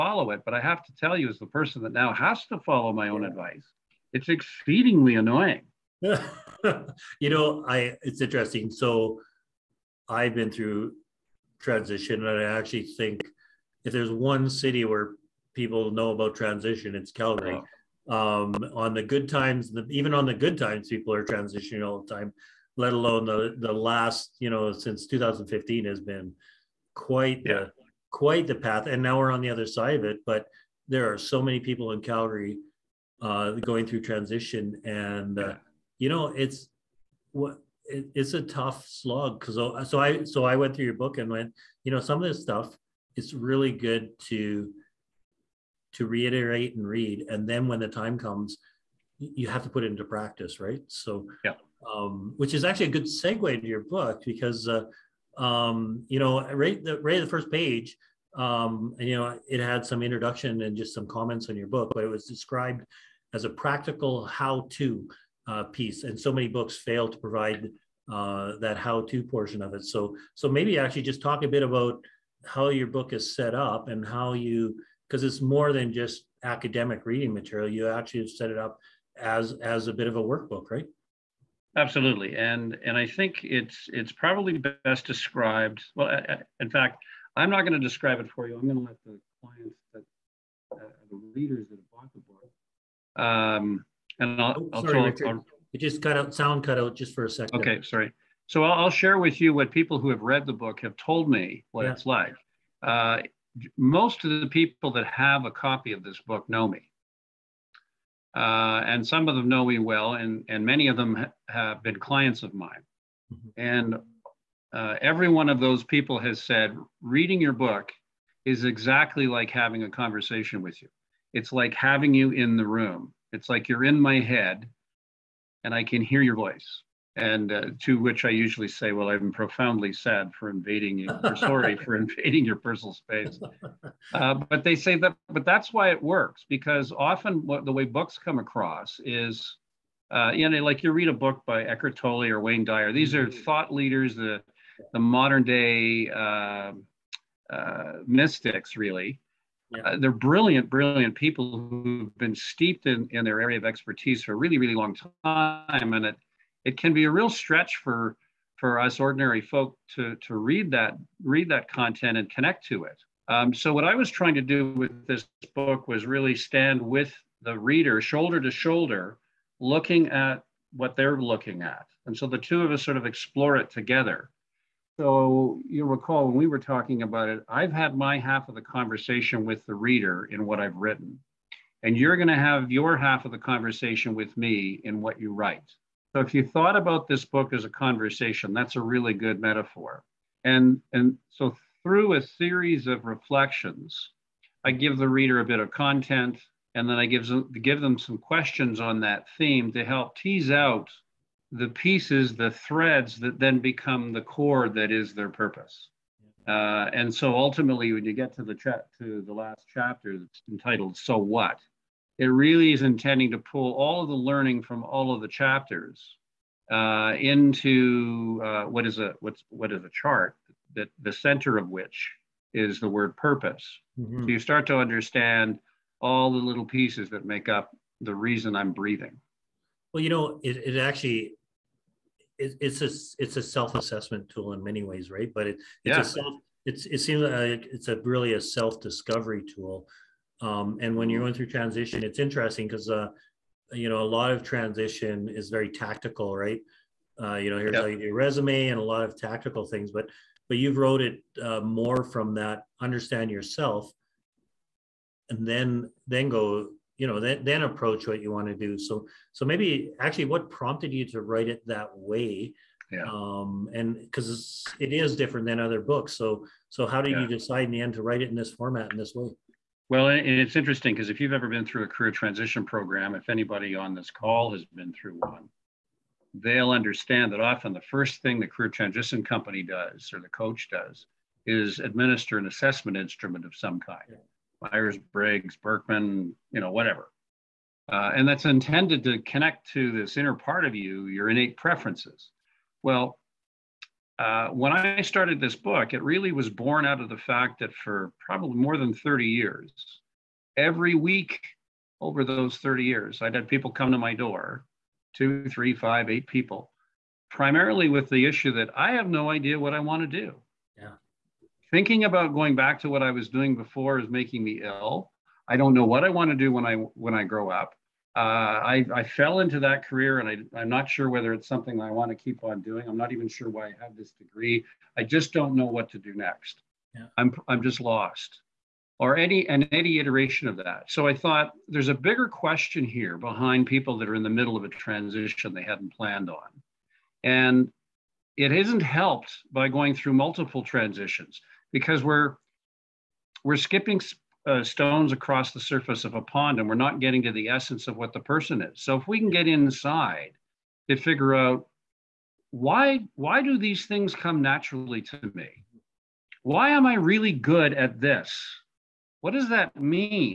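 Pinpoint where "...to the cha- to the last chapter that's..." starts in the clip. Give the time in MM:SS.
03:28.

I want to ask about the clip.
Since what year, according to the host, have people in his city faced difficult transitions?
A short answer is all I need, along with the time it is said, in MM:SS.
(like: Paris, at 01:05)
2015, at 00:25.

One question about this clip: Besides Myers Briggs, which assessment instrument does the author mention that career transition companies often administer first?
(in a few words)
Birkman.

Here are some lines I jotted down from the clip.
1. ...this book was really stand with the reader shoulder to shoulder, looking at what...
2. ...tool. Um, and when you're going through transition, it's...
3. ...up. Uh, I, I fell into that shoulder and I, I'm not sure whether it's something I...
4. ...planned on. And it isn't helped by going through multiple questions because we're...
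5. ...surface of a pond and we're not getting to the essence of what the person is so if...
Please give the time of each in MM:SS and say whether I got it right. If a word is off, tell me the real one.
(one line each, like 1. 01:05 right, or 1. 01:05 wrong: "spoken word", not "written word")
1. 02:45 right
2. 03:59 right
3. 05:17 wrong: "career", not "shoulder"
4. 05:35 wrong: "transitions", not "questions"
5. 05:45 right.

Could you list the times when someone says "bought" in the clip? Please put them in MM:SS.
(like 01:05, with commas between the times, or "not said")
01:31.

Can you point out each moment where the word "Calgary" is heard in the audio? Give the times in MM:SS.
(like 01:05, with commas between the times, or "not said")
00:17, 00:32.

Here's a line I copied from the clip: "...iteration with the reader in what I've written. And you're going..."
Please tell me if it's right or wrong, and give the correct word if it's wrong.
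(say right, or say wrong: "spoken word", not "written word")
wrong: "conversation", not "iteration".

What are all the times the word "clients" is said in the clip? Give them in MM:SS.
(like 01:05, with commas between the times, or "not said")
01:29, 01:51.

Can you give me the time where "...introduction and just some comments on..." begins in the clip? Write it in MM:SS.
01:00.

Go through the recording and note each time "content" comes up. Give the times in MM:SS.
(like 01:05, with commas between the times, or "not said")
02:41, 03:15.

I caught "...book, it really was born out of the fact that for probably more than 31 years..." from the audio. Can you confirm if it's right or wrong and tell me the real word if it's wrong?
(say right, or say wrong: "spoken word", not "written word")
wrong: "30", not "31".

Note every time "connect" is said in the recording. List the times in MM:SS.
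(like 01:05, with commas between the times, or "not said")
02:42, 04:49.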